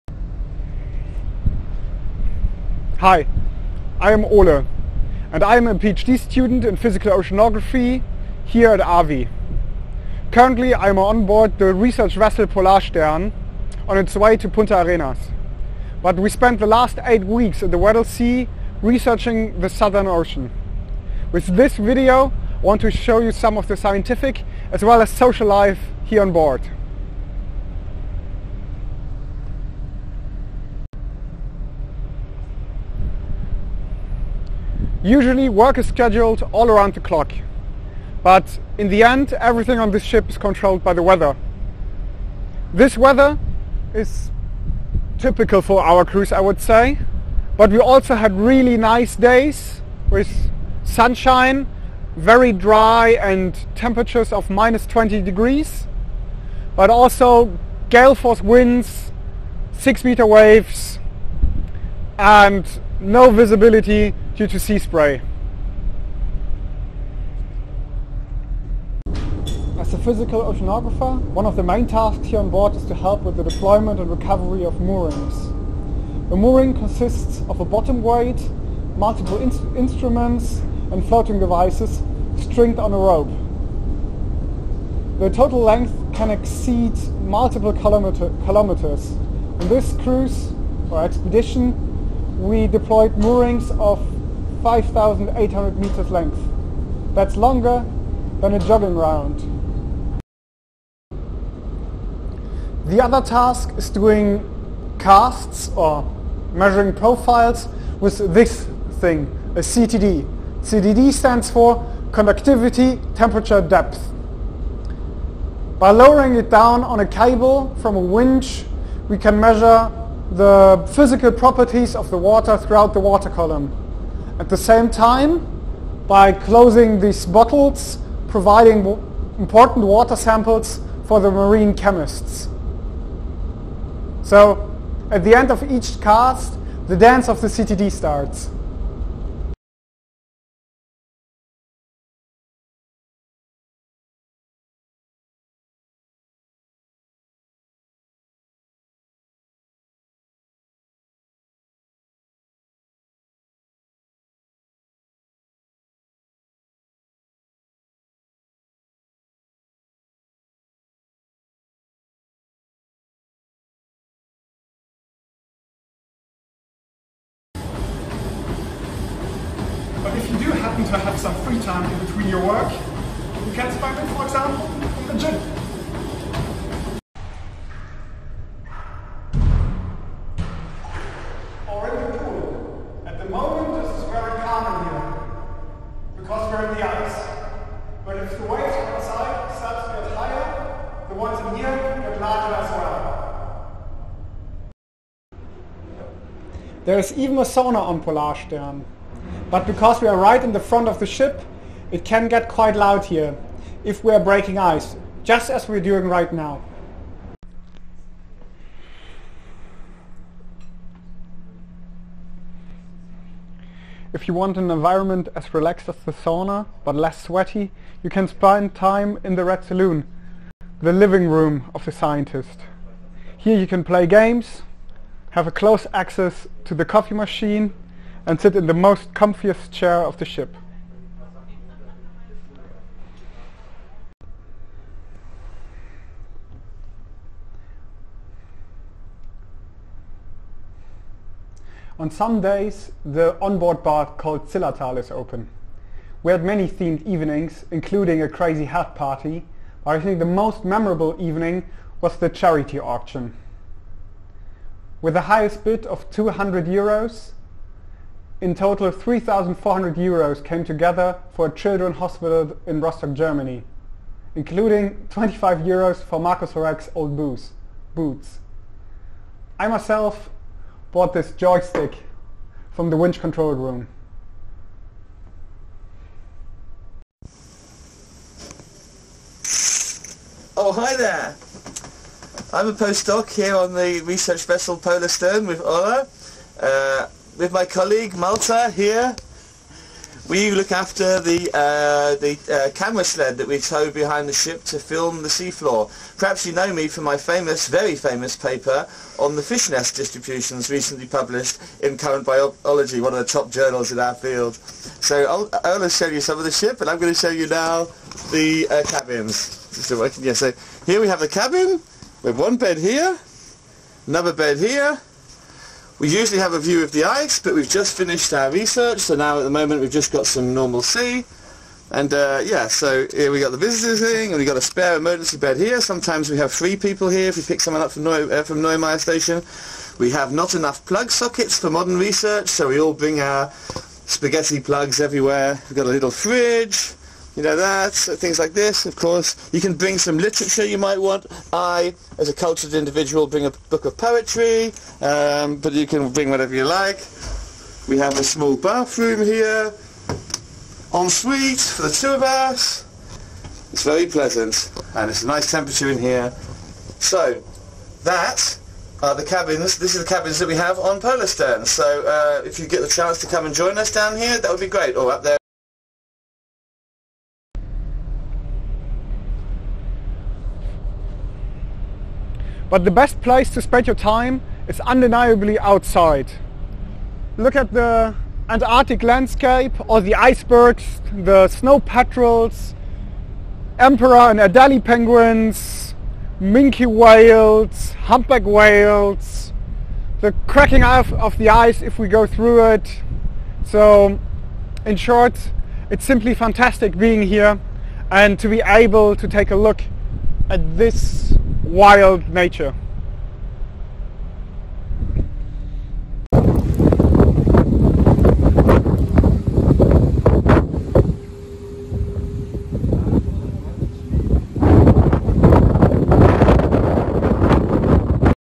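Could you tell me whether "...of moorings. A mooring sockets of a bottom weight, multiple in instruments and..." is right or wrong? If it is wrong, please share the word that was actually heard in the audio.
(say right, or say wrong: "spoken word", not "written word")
wrong: "consists", not "sockets".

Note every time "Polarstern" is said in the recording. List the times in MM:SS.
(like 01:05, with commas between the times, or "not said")
00:12, 03:18, 04:44, 06:00.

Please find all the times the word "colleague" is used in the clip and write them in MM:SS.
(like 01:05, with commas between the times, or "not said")
04:47.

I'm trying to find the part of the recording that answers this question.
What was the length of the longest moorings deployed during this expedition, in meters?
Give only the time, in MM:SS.
01:34.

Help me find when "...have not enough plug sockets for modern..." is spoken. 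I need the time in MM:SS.
05:30.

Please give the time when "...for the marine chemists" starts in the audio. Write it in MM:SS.
02:11.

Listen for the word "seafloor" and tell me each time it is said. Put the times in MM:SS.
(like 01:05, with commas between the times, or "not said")
04:55.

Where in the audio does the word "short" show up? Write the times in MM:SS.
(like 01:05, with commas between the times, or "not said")
06:34.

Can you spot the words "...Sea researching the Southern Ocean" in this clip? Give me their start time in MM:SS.
00:18.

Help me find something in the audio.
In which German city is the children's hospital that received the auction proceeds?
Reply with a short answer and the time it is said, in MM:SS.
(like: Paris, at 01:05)
Rostock, at 04:22.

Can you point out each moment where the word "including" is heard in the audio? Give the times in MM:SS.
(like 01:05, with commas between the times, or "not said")
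04:07, 04:24.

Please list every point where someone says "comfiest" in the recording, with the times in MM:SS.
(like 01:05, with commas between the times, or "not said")
03:49.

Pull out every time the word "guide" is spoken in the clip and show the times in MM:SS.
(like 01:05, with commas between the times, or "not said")
not said.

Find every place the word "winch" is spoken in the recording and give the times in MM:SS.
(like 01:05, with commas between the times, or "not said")
01:57, 04:32.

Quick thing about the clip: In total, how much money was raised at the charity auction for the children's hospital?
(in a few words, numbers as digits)
3,400 euros.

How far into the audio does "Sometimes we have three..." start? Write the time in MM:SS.
05:25.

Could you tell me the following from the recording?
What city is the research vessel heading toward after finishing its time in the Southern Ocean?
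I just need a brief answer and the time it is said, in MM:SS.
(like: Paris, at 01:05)
Punta Arenas, at 00:14.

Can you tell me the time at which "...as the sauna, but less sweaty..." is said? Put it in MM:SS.
03:35.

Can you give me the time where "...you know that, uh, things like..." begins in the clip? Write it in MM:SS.
05:37.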